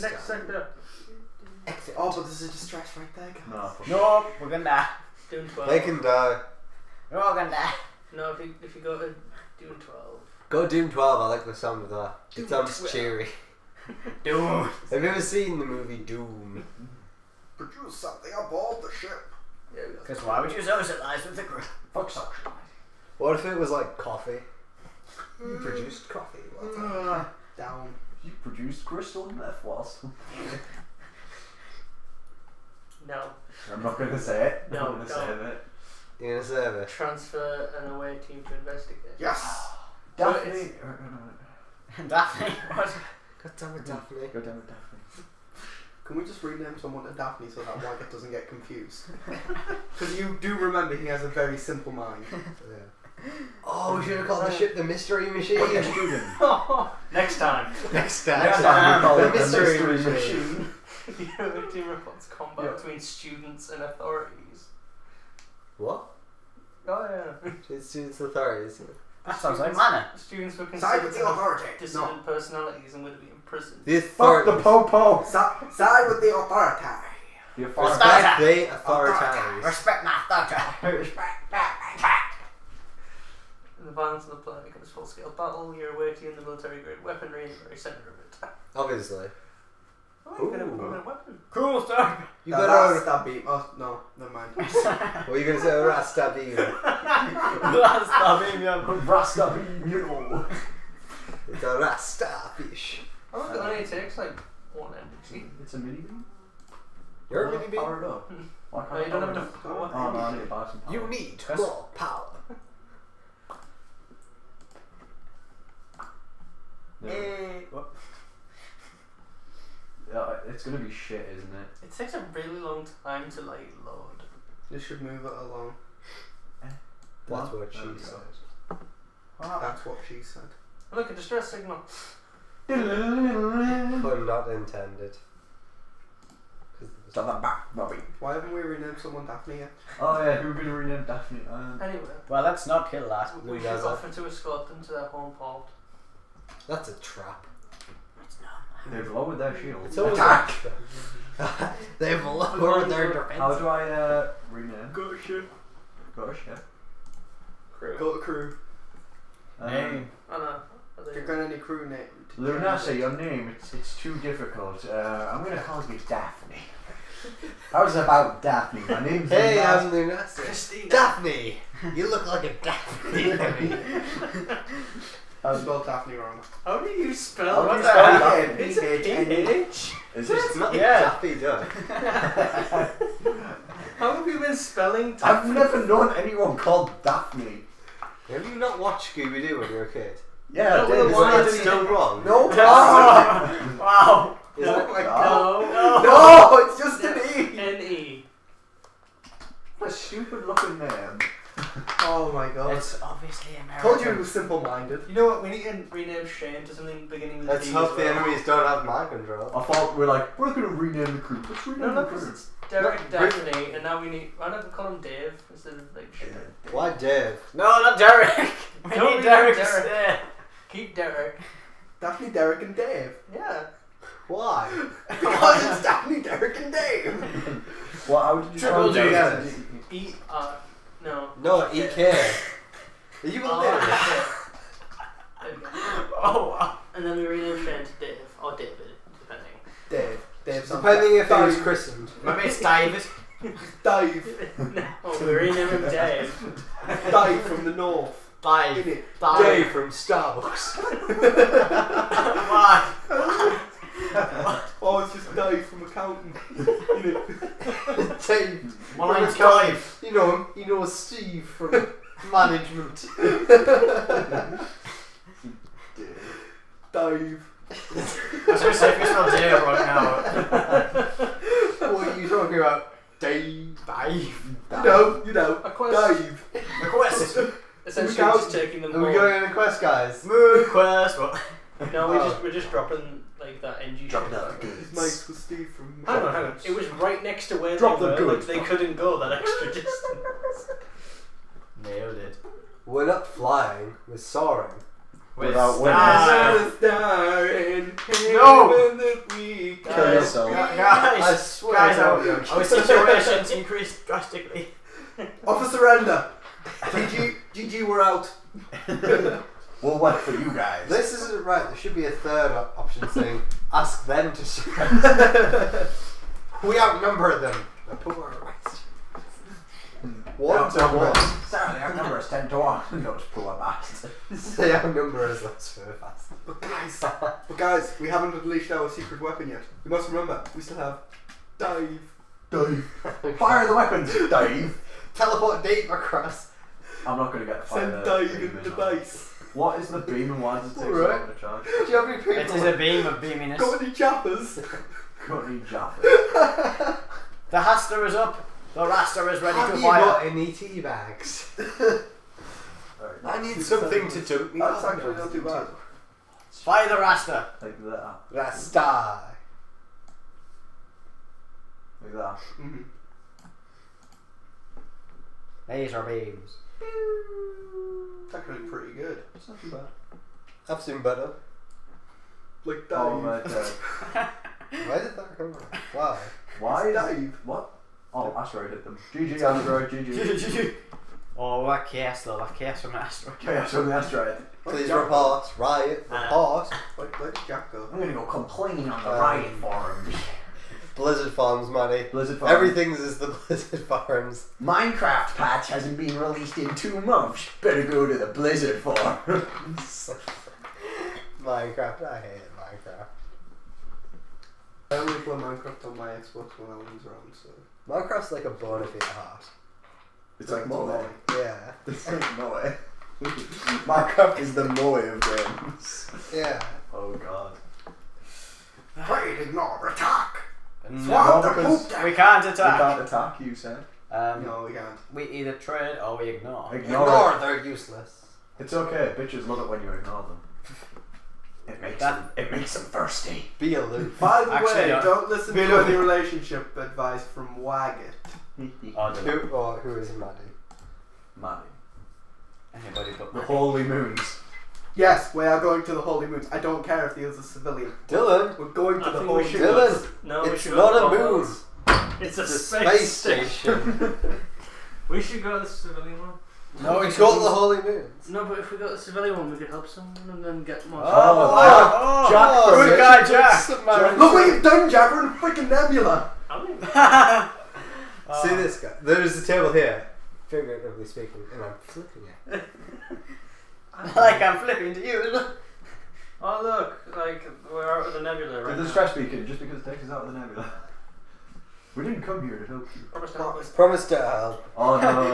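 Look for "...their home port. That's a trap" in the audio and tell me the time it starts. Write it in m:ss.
2:24.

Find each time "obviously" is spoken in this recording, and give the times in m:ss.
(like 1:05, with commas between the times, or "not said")
1:28, 3:23.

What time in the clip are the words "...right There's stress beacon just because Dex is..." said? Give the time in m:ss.
7:58.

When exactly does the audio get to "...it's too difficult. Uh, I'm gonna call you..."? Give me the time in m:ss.
2:43.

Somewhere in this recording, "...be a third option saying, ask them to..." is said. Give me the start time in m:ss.
5:11.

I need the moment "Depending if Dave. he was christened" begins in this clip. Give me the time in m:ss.
4:00.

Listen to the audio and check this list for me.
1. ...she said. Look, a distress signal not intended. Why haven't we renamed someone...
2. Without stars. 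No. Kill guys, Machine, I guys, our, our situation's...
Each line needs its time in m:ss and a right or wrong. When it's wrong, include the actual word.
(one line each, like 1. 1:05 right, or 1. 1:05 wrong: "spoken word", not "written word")
1. 2:10 right
2. 4:55 wrong: "Guys", not "Machine".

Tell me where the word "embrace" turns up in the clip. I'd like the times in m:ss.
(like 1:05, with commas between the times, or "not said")
not said.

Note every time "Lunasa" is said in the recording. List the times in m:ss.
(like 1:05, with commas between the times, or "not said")
2:42, 2:49.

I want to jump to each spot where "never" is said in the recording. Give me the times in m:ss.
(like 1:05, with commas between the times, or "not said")
1:34, 3:05.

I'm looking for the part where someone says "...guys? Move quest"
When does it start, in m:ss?
4:39.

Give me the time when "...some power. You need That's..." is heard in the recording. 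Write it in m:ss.
1:50.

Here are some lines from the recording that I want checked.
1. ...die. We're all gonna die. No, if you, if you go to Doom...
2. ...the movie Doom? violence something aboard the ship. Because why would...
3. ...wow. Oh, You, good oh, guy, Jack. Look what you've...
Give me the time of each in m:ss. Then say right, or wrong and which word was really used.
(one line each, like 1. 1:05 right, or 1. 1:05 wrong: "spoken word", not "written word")
1. 0:06 right
2. 0:15 wrong: "produce", not "violence"
3. 7:41 wrong: "Jack", not "You".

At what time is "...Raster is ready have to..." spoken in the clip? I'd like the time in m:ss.
5:48.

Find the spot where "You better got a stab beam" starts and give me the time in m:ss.
1:32.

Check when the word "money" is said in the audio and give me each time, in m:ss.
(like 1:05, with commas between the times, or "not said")
6:31.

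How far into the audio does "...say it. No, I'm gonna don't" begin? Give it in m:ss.
0:34.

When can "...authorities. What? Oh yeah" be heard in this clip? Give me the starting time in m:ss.
1:03.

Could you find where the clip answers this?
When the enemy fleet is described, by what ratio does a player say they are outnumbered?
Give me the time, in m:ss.
5:22.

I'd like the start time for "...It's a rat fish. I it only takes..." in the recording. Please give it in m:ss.
1:41.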